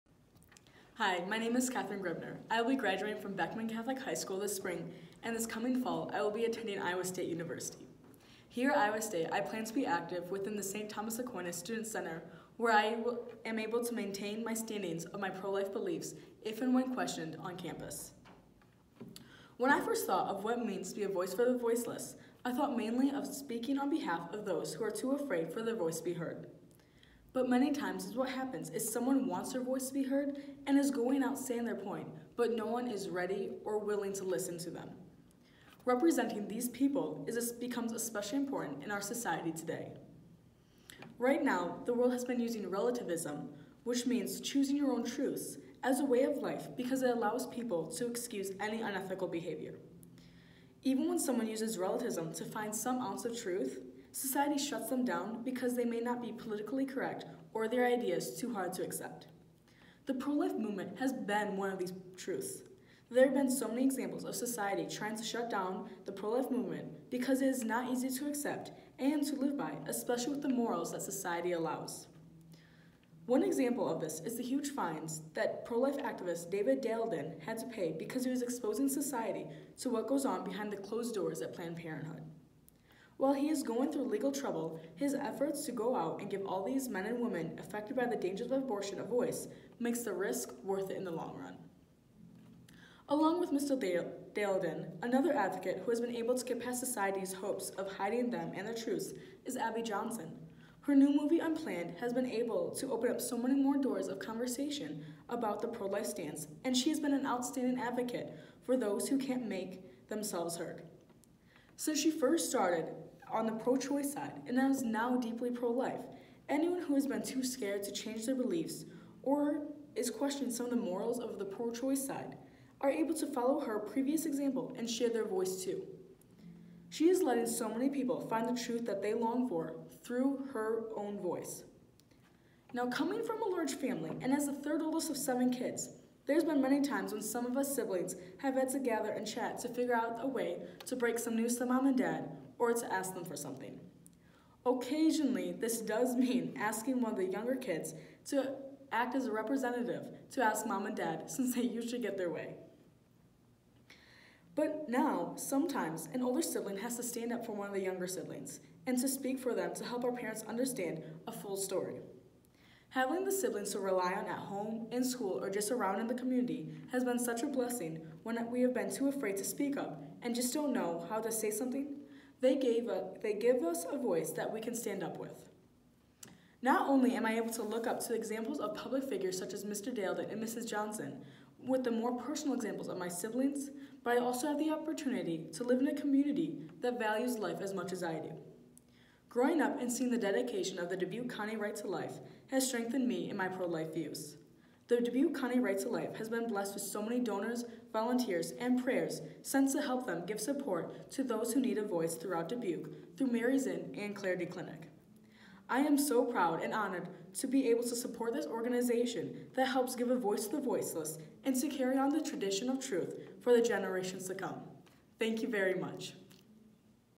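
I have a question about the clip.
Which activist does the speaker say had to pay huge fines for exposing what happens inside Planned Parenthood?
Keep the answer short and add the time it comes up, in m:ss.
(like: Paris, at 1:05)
David Daleden, at 1:16.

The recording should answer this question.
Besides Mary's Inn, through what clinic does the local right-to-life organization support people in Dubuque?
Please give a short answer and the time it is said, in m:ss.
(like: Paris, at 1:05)
Clarity Clinic, at 3:24.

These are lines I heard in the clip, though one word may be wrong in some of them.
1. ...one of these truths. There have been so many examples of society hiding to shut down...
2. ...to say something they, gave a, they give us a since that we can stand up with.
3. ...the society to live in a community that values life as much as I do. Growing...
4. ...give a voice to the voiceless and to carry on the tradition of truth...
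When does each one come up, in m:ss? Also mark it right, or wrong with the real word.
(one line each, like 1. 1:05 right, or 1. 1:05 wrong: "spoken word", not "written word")
1. 1:01 wrong: "trying", not "hiding"
2. 2:51 wrong: "voice", not "since"
3. 3:04 wrong: "opportunity", not "society"
4. 3:29 right.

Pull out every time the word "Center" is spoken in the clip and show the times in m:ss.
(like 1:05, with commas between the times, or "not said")
0:11.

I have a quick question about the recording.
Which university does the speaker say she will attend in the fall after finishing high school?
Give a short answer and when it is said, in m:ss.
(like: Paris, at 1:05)
Iowa State University, at 0:06.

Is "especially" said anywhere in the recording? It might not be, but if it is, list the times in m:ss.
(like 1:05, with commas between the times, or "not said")
0:37, 1:09.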